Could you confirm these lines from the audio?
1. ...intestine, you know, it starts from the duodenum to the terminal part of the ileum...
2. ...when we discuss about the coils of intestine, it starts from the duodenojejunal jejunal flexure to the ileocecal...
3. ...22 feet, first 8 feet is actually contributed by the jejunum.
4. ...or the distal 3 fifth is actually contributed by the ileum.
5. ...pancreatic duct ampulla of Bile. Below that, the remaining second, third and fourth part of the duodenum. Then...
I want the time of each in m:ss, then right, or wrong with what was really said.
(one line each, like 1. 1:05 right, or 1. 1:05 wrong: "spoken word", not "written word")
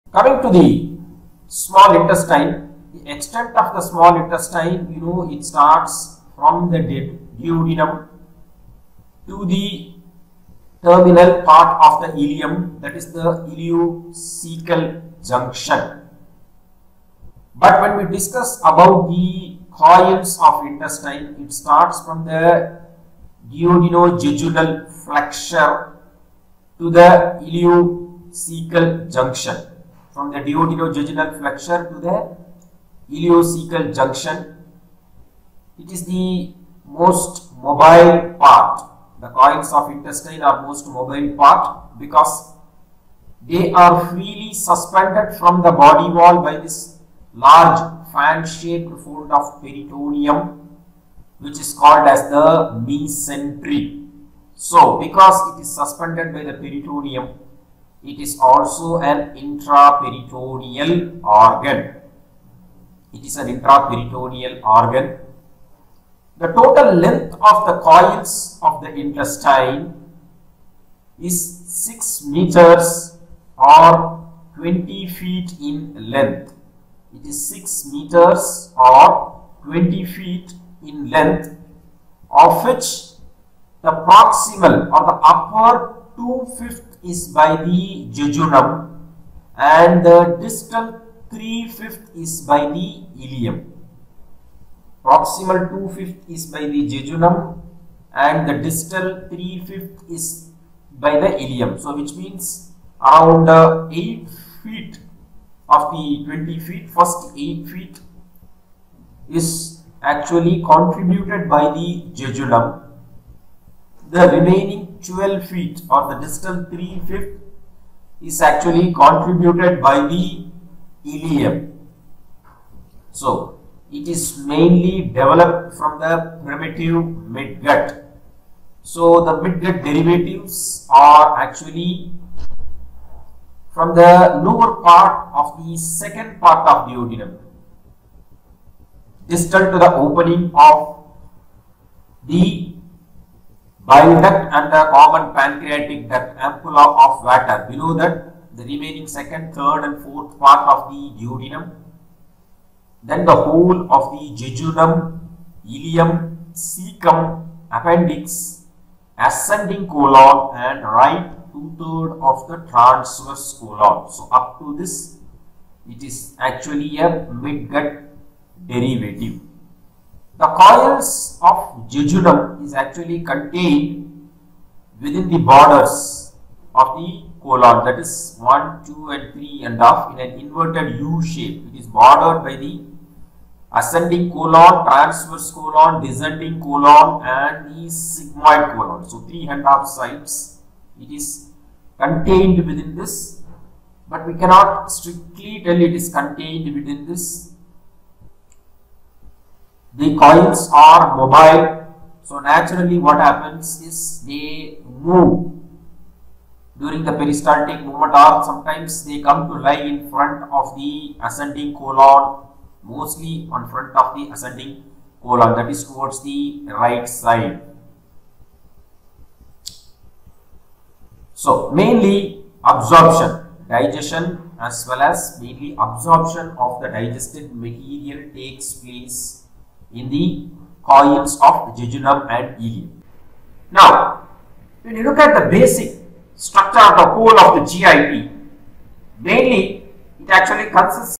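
1. 0:04 right
2. 0:17 right
3. 1:46 wrong: "20", not "22"
4. 1:55 right
5. 2:25 wrong: "Vater", not "Bile".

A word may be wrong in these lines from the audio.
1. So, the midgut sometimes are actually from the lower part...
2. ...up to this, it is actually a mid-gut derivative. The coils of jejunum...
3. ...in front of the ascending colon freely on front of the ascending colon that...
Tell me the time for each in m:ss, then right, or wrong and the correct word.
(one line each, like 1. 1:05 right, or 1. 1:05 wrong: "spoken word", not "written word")
1. 2:08 wrong: "derivatives", not "sometimes"
2. 2:44 right
3. 3:29 wrong: "mostly", not "freely".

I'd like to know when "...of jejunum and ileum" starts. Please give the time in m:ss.
3:51.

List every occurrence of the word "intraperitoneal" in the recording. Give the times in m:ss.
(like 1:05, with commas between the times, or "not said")
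0:59, 1:03.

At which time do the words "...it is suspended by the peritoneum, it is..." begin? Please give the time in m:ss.
0:55.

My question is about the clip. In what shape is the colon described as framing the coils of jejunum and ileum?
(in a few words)
Inverted U shape.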